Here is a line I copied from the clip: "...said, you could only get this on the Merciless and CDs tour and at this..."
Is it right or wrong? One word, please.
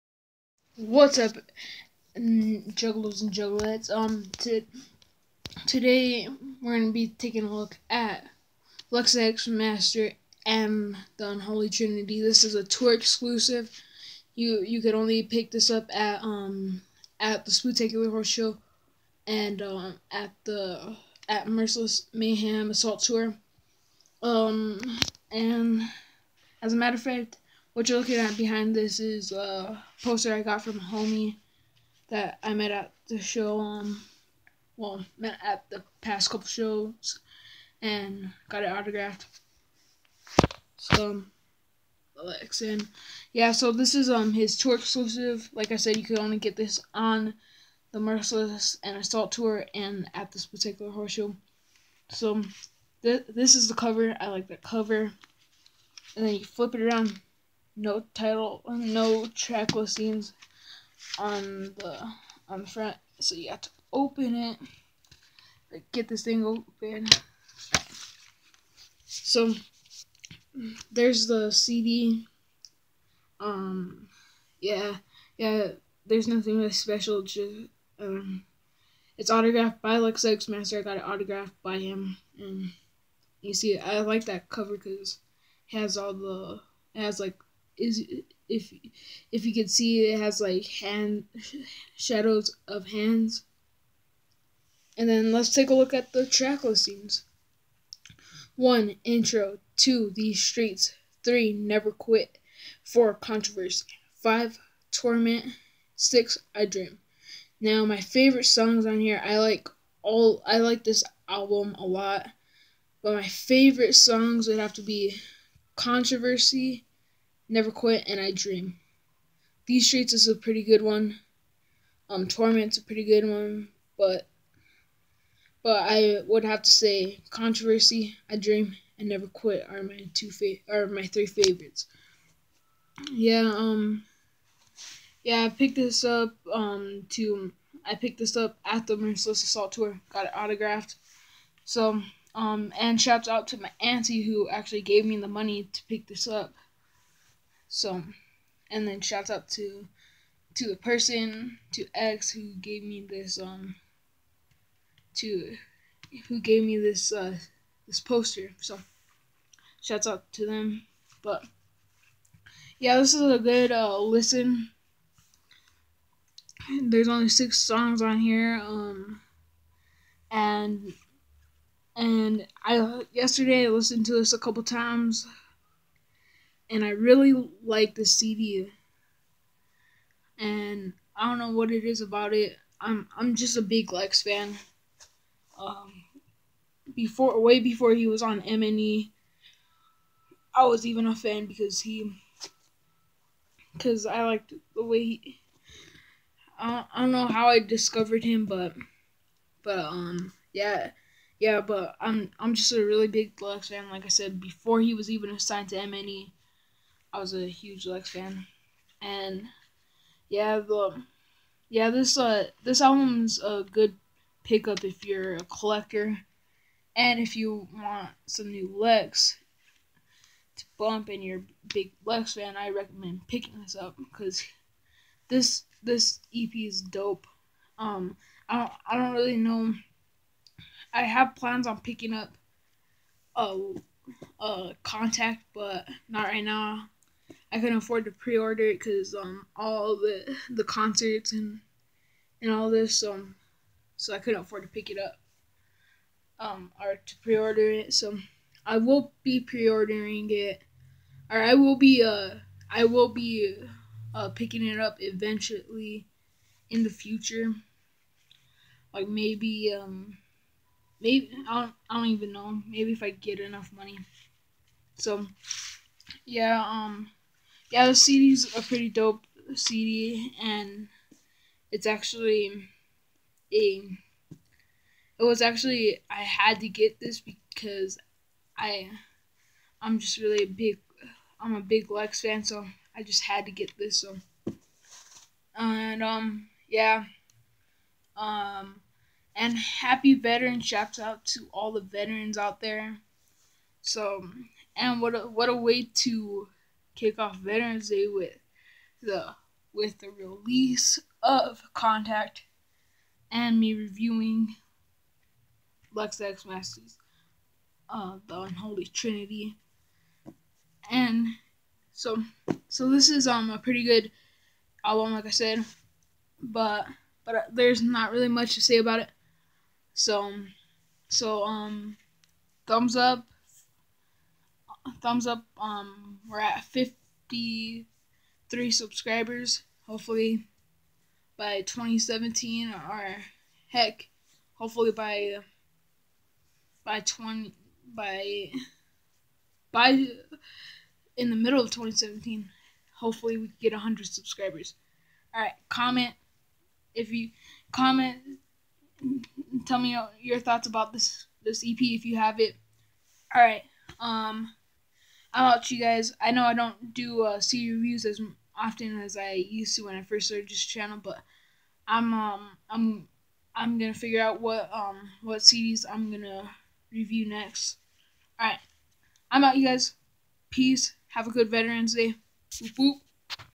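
wrong.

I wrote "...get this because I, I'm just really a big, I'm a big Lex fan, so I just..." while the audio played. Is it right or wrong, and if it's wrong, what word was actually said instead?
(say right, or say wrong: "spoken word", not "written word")
right.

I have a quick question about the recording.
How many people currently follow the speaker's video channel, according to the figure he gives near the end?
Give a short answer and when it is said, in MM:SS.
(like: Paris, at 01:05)
53, at 05:26.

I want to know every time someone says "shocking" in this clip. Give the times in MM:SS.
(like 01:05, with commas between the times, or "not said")
not said.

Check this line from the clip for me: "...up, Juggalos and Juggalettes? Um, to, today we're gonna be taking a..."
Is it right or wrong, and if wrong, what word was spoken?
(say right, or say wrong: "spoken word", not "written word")
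right.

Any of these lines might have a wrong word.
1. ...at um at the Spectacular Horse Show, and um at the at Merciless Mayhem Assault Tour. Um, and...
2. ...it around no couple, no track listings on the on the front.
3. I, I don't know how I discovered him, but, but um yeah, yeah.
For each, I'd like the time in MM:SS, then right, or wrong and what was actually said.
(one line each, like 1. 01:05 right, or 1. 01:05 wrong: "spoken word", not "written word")
1. 00:15 right
2. 00:56 wrong: "title", not "couple"
3. 03:16 right.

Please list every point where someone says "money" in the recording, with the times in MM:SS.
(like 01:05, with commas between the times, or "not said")
02:25, 04:23.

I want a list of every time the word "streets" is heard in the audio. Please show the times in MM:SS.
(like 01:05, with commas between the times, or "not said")
01:40, 01:59.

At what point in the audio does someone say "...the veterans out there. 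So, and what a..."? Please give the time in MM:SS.
04:51.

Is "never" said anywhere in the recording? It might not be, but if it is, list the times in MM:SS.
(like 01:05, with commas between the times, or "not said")
01:41, 01:57, 02:09.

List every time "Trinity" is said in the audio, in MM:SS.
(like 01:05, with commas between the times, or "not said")
00:11, 05:08.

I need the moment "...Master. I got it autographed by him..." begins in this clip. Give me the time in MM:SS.
01:20.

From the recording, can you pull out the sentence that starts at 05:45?
All right, comment if you comment tell me your thoughts about this this EP if you have it.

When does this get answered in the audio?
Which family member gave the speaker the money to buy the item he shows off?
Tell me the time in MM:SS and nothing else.
02:23.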